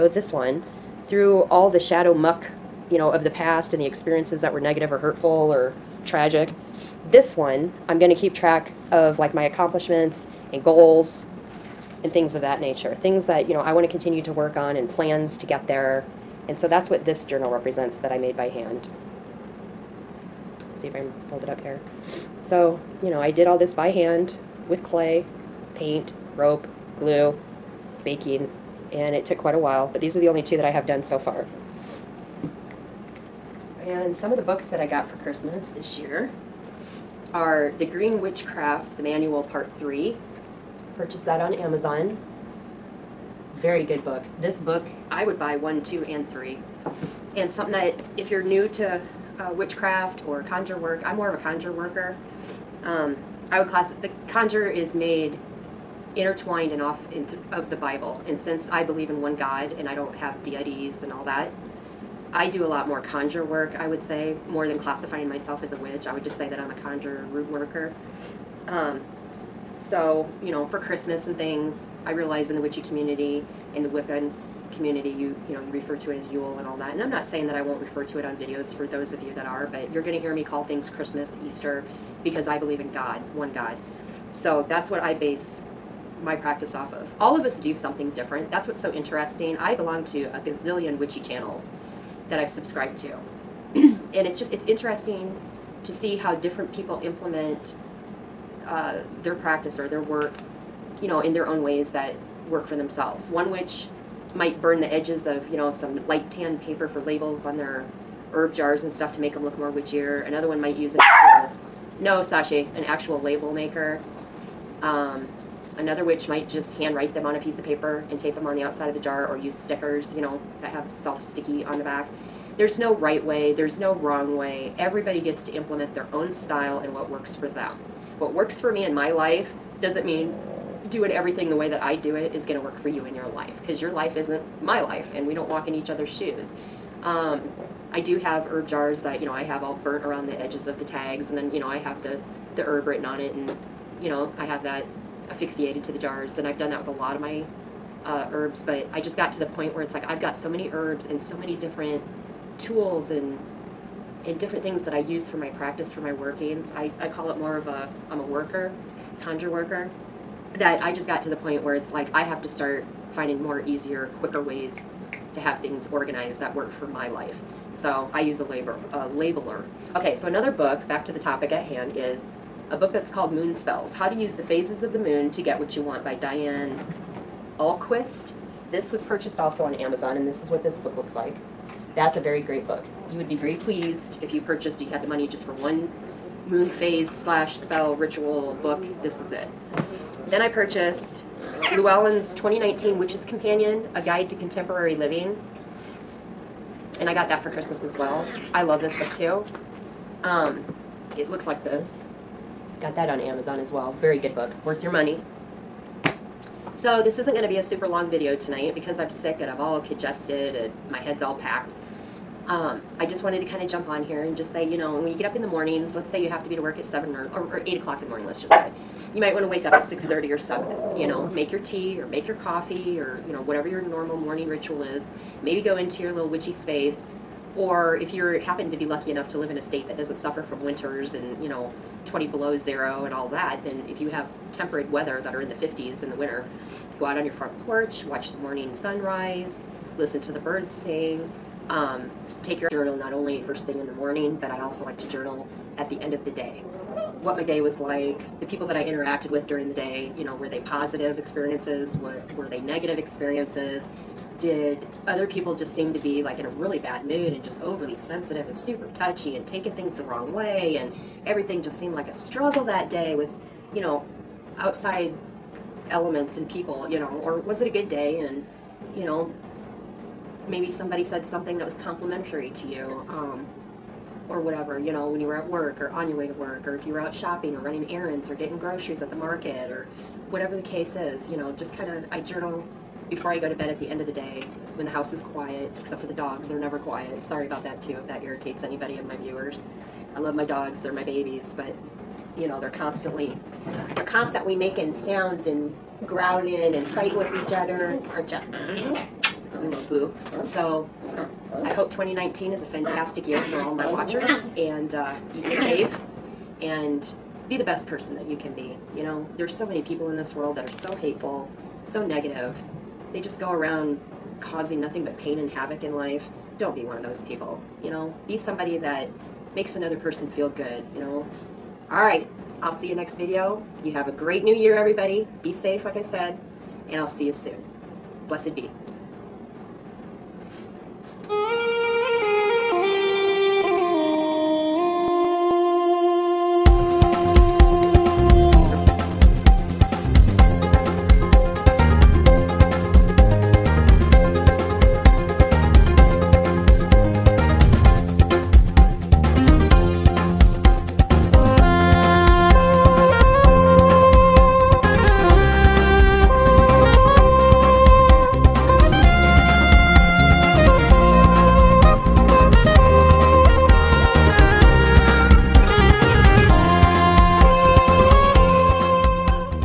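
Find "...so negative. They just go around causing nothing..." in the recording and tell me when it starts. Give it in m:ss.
5:11.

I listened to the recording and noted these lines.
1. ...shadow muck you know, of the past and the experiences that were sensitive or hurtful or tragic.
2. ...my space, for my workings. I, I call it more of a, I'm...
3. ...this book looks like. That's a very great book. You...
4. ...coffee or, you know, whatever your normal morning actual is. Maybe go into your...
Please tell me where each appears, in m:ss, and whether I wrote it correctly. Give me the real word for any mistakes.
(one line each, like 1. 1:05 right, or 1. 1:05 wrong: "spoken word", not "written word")
1. 0:01 wrong: "negative", not "sensitive"
2. 2:35 wrong: "practice", not "space"
3. 3:00 right
4. 3:42 wrong: "ritual", not "actual".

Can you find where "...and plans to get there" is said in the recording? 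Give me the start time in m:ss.
0:14.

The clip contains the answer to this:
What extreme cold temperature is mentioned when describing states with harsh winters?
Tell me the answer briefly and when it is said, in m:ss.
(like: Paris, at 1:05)
20 below zero, at 3:52.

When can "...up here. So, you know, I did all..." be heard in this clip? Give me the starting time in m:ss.
0:21.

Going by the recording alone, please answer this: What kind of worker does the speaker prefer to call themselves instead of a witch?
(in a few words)
conjure root worker.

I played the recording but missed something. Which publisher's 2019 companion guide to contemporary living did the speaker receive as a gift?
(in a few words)
Llewellyn's.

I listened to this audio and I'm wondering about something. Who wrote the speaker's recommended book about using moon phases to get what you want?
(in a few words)
Diane Ahlquist.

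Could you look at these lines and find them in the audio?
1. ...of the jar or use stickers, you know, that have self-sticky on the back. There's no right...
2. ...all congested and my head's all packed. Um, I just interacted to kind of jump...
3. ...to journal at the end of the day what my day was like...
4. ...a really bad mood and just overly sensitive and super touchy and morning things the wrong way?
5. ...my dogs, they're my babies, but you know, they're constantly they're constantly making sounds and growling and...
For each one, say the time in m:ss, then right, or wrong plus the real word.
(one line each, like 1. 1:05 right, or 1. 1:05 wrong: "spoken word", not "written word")
1. 1:58 right
2. 3:29 wrong: "wanted", not "interacted"
3. 4:04 right
4. 4:16 wrong: "taking", not "morning"
5. 4:50 right.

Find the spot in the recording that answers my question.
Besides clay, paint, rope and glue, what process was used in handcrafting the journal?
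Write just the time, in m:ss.
0:28.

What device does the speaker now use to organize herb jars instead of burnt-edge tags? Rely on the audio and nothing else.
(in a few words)
a labeler.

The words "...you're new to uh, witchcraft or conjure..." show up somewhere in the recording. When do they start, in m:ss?
0:48.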